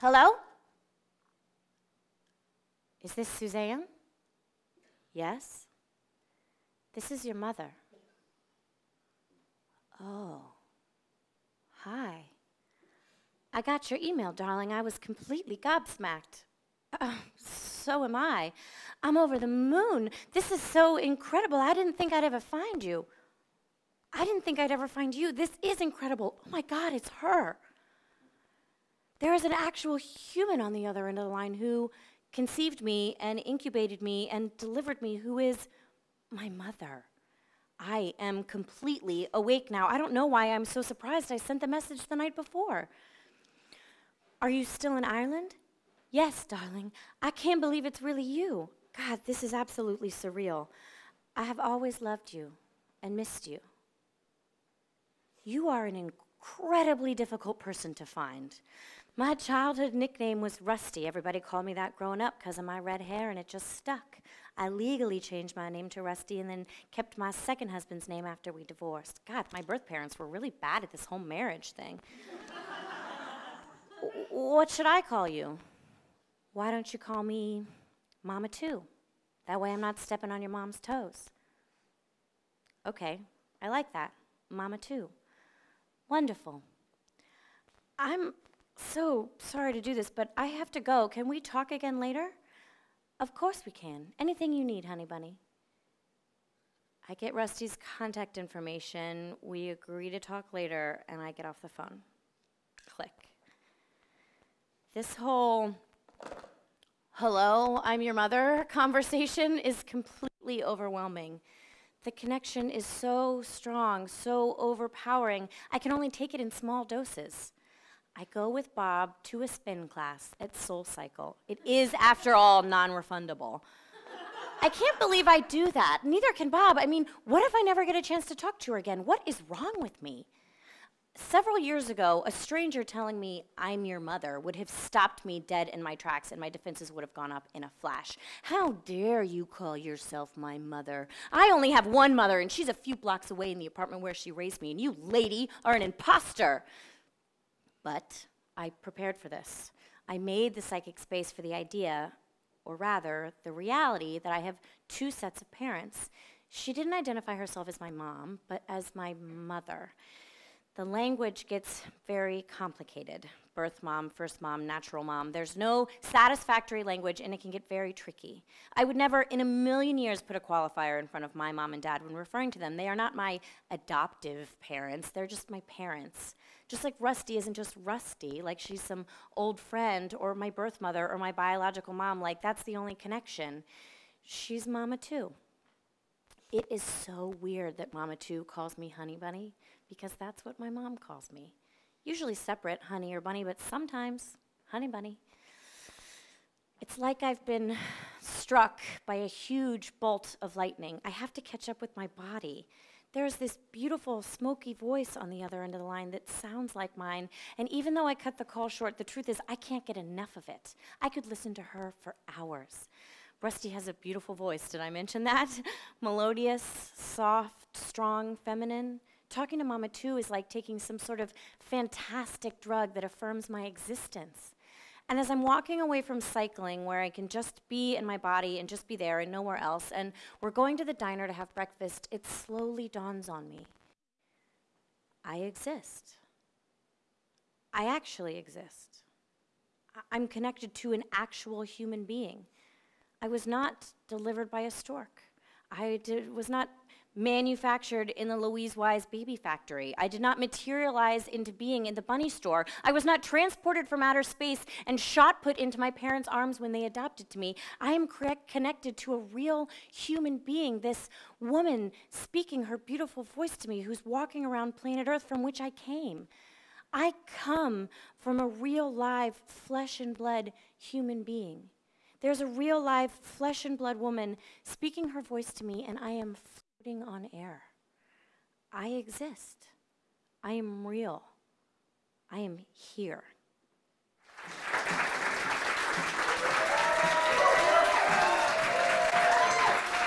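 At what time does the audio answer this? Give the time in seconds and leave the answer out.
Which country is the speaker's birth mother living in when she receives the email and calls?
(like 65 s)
45 s.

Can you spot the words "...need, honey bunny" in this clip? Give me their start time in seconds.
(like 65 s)
94 s.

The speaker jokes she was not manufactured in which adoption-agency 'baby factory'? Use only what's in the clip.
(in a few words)
Louise Wise.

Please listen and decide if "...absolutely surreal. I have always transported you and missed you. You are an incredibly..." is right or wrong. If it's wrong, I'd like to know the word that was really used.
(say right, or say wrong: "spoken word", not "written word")
wrong: "loved", not "transported".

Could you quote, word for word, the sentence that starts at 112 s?
The connection is so strong, so overpowering, I can only take it in small doses.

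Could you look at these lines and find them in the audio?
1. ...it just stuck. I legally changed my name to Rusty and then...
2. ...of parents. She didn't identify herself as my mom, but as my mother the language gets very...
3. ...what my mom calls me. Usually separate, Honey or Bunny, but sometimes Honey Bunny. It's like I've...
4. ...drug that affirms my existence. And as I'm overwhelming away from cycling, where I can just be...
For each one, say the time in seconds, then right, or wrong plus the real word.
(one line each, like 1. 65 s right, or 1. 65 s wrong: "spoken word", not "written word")
1. 63 s right
2. 155 s right
3. 190 s right
4. 222 s wrong: "walking", not "overwhelming".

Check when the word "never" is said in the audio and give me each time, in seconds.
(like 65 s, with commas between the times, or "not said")
127 s, 168 s.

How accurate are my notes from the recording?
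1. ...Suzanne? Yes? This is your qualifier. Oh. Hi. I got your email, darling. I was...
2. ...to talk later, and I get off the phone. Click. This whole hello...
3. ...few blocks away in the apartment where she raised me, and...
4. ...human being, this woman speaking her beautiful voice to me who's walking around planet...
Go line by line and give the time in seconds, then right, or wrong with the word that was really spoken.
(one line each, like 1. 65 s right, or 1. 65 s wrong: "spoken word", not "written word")
1. 3 s wrong: "mother", not "qualifier"
2. 100 s right
3. 142 s right
4. 259 s right.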